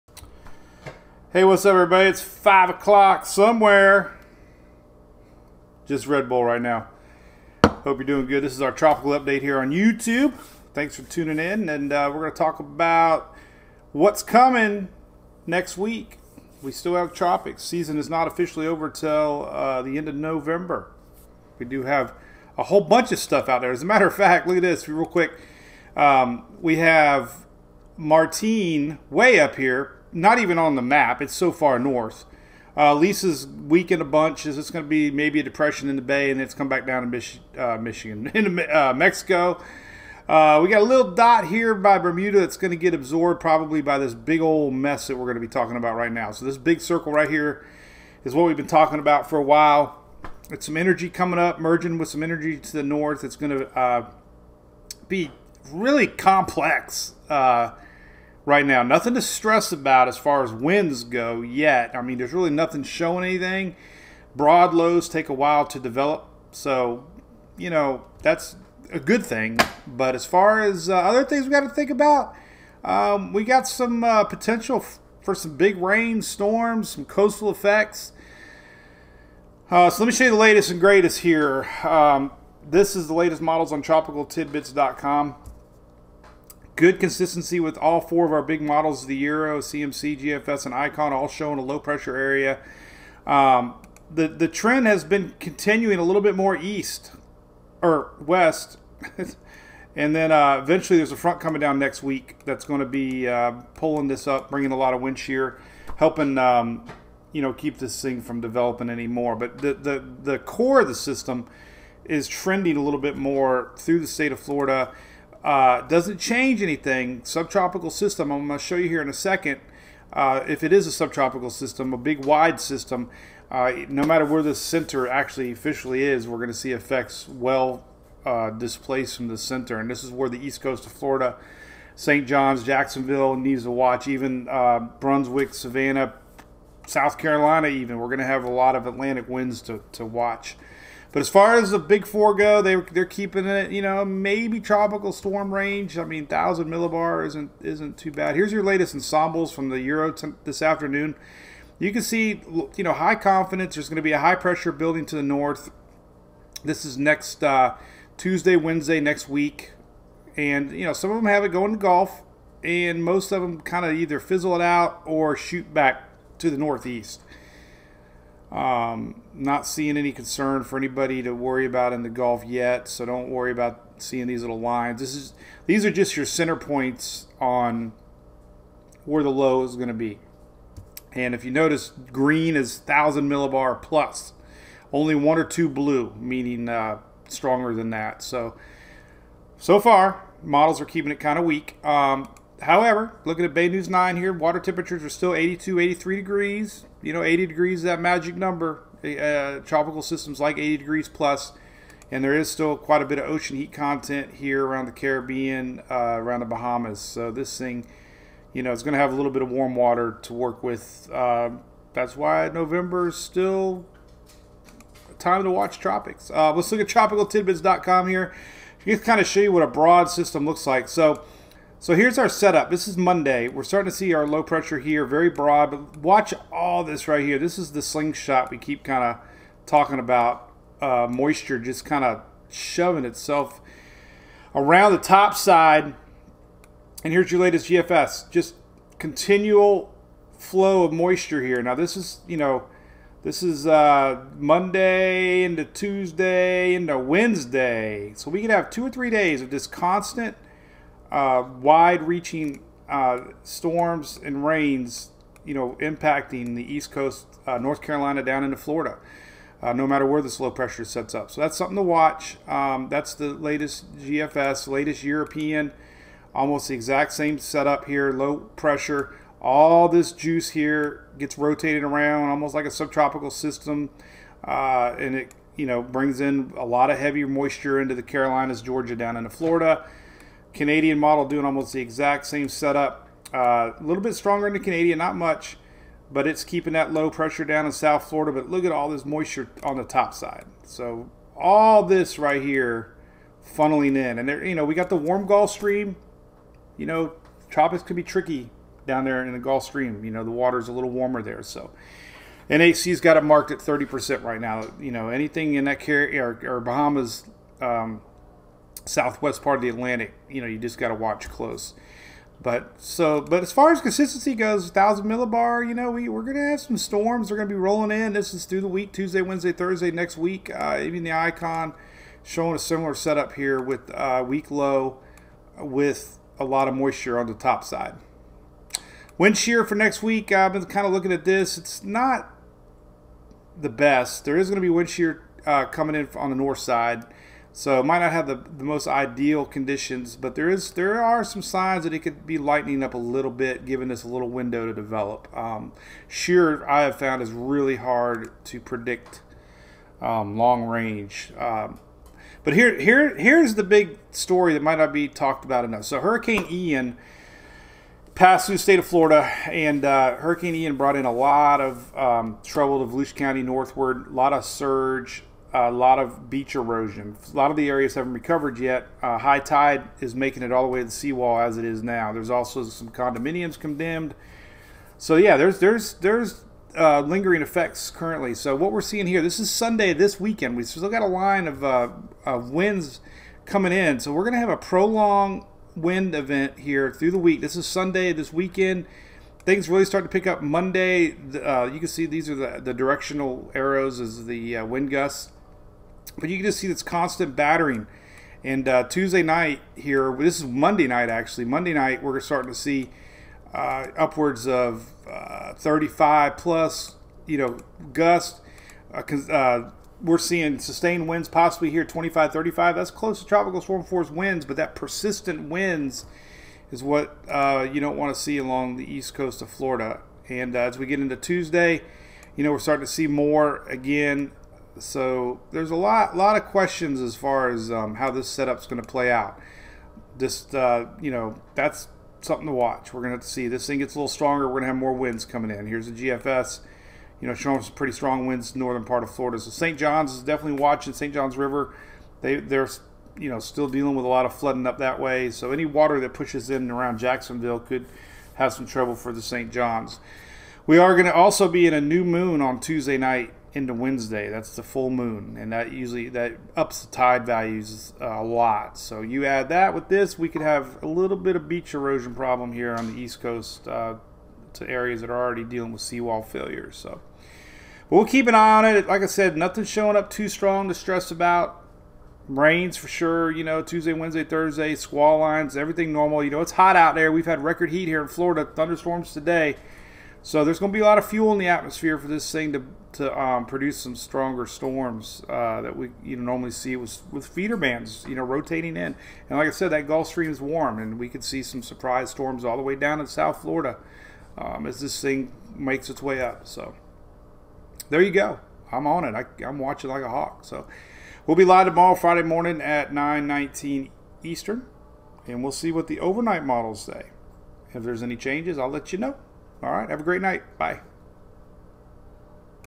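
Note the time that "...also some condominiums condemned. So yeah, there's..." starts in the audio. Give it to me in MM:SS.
06:12.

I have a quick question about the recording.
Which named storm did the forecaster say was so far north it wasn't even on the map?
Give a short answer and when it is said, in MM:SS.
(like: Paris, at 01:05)
Martin, at 00:27.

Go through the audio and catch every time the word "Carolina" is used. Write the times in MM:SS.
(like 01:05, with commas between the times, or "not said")
02:17, 04:17, 04:38.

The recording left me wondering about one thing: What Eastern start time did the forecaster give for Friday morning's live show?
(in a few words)
9:19.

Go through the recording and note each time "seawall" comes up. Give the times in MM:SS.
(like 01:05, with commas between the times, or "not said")
06:10, 07:45.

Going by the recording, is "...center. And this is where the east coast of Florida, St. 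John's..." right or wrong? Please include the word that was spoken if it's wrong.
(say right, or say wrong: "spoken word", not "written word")
right.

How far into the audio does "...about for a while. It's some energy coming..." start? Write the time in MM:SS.
00:48.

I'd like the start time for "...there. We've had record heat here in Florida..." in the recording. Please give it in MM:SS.
07:56.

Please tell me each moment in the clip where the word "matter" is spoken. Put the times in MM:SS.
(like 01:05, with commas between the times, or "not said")
00:23, 02:04, 04:19.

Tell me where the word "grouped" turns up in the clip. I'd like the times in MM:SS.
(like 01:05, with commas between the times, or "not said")
not said.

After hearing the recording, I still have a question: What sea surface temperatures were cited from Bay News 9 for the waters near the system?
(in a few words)
82, 83 degrees.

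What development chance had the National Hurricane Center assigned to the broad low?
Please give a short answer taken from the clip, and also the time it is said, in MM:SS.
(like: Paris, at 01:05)
30%, at 05:03.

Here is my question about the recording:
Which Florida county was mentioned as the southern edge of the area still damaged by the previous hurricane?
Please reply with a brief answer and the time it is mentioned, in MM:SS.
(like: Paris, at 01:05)
Volusia County, at 06:02.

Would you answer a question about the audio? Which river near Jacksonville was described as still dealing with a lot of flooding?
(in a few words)
St. John's River.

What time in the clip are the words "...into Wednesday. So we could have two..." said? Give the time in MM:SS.
04:06.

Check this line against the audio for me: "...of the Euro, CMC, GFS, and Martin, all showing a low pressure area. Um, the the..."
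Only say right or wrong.
wrong.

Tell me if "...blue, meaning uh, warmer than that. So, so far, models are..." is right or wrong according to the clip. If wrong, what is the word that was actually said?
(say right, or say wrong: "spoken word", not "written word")
wrong: "stronger", not "warmer".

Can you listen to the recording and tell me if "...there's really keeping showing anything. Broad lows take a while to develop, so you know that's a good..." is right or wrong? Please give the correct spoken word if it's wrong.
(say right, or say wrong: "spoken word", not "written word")
wrong: "nothing", not "keeping".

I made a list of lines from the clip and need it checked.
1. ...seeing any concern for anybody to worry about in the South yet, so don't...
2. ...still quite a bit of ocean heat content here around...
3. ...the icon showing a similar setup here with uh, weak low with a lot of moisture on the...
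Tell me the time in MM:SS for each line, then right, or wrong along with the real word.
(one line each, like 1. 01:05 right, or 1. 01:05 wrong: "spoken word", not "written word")
1. 02:49 wrong: "Gulf", not "South"
2. 03:22 right
3. 05:21 right.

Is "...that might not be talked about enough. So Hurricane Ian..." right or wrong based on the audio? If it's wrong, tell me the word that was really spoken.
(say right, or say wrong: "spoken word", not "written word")
right.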